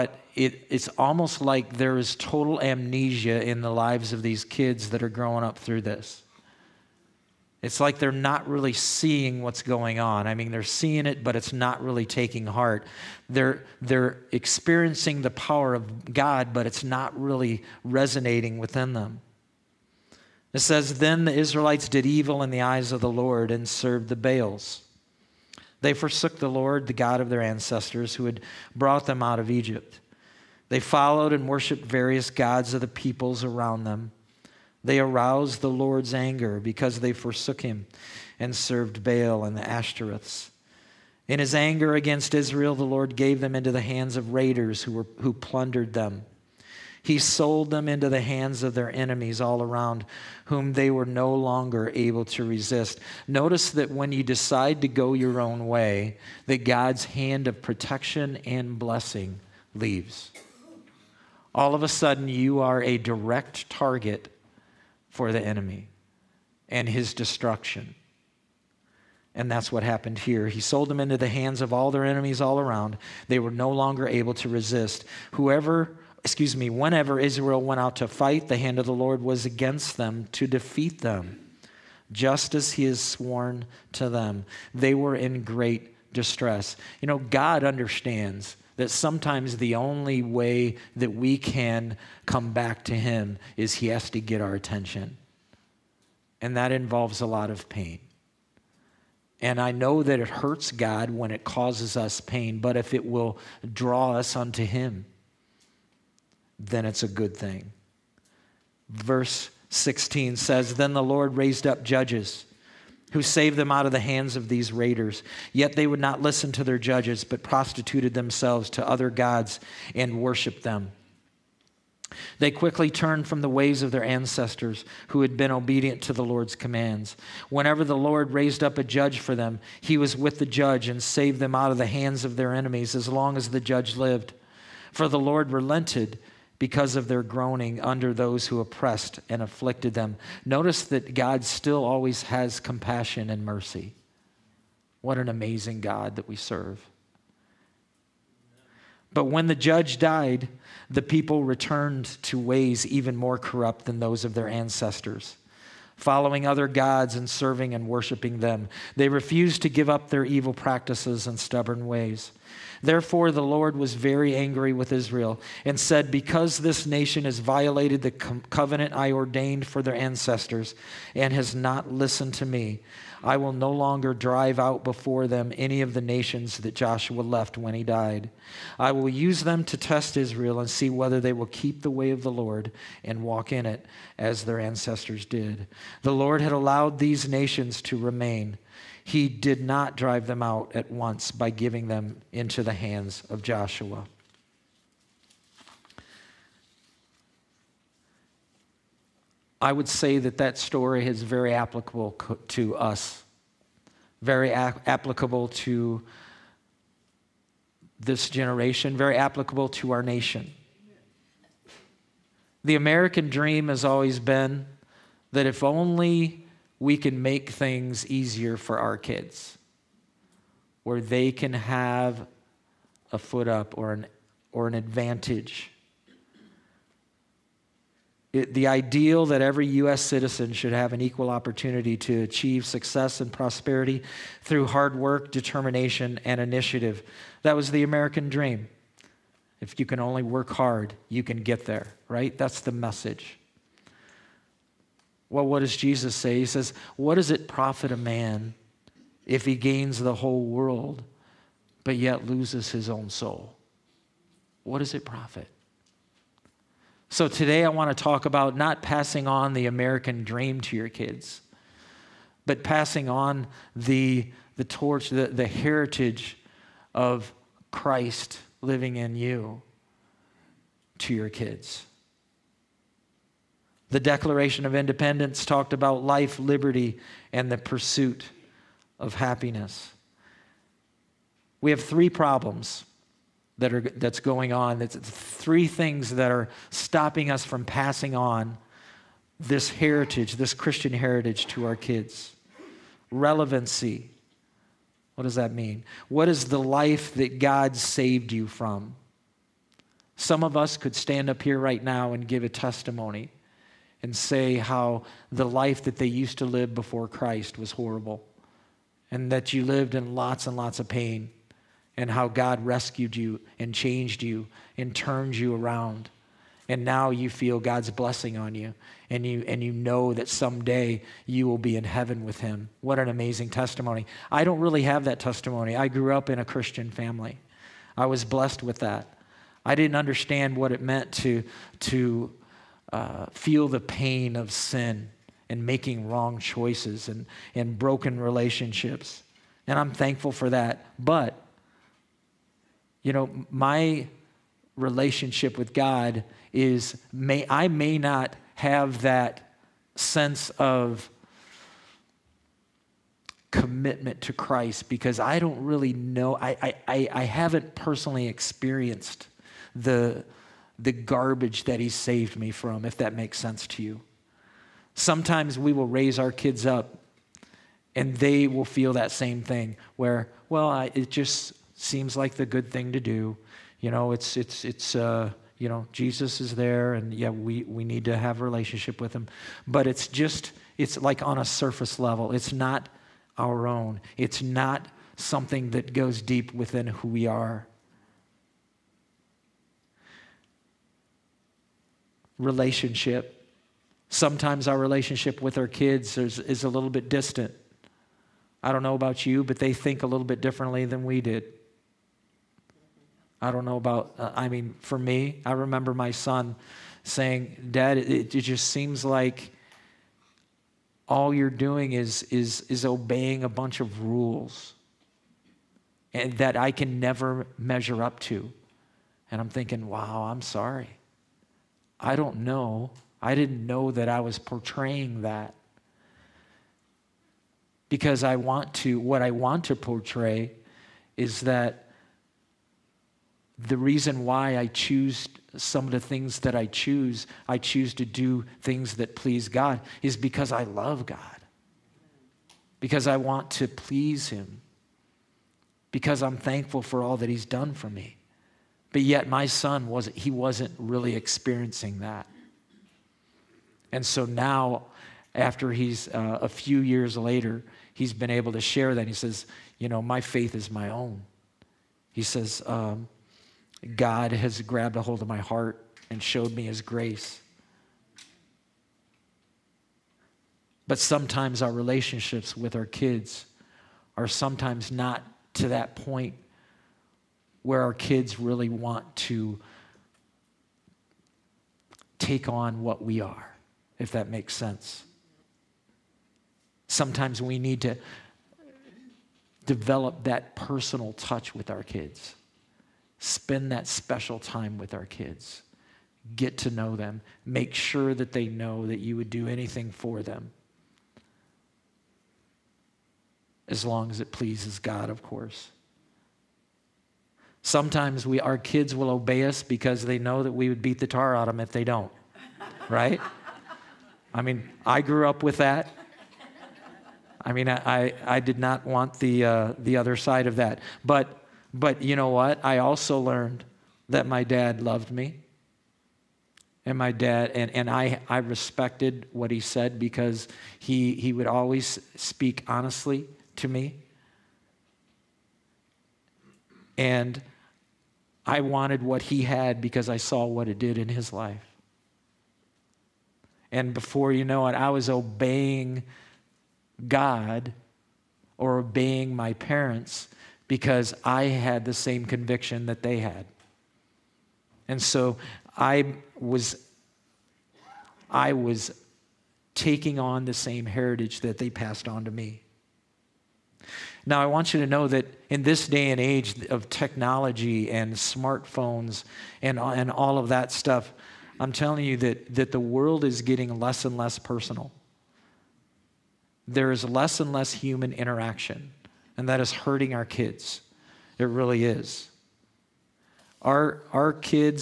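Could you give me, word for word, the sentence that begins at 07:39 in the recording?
He says, You know, my faith is my own.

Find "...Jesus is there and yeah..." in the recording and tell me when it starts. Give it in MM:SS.
06:15.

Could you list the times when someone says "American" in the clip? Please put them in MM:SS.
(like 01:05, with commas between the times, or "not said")
03:32, 03:57, 04:19.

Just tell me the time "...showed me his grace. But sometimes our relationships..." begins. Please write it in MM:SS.
07:46.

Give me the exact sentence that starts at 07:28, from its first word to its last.
But yet, my son wasn't, he wasn't really experiencing that.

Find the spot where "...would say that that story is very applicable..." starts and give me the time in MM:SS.
03:19.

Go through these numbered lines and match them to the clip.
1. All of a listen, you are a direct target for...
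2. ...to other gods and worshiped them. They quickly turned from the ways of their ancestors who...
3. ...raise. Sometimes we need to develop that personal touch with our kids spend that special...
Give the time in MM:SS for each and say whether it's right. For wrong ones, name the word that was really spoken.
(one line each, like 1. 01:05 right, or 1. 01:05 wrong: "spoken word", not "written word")
1. 01:01 wrong: "sudden", not "listen"
2. 01:58 right
3. 08:04 wrong: "sense", not "raise".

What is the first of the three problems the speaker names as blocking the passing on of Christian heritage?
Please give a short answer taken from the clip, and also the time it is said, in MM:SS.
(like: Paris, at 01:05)
Relevancy, at 04:53.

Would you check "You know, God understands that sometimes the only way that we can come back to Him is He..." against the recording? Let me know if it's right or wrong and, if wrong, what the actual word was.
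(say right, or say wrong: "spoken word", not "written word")
right.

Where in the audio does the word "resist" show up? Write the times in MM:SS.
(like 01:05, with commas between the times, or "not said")
00:52, 01:14.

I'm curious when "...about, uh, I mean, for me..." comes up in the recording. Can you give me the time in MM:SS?
06:43.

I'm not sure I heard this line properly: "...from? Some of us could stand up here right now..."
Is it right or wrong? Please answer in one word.
right.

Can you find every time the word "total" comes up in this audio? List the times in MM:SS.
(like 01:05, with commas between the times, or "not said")
00:02.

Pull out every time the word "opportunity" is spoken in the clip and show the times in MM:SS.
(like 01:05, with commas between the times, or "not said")
03:51.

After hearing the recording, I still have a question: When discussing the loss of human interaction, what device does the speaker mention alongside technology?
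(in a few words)
Smartphones.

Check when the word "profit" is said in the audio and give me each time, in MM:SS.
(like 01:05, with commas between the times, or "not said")
04:07, 04:15.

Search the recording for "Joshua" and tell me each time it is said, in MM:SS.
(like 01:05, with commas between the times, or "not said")
02:56, 03:13.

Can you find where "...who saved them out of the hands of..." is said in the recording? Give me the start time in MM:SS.
01:53.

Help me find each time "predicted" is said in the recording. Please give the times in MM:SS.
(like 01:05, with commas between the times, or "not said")
not said.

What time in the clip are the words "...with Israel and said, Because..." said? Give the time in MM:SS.
02:44.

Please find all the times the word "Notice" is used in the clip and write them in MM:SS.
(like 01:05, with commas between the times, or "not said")
00:53, 02:20.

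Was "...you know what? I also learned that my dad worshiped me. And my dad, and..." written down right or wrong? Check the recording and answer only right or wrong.
wrong.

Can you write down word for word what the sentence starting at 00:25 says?
They forsook the Lord, the God of their ancestors, who had brought them out of Egypt.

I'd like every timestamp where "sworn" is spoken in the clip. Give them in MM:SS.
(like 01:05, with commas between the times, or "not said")
01:23.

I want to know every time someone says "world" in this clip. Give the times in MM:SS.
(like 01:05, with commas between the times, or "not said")
04:10, 09:32.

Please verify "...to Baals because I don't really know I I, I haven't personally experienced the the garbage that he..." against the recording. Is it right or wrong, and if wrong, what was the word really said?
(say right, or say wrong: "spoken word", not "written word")
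wrong: "Christ", not "Baals".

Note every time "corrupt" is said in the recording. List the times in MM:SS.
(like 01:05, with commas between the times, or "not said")
02:33.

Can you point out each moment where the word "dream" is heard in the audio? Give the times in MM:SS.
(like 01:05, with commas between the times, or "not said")
03:33, 03:58, 04:20.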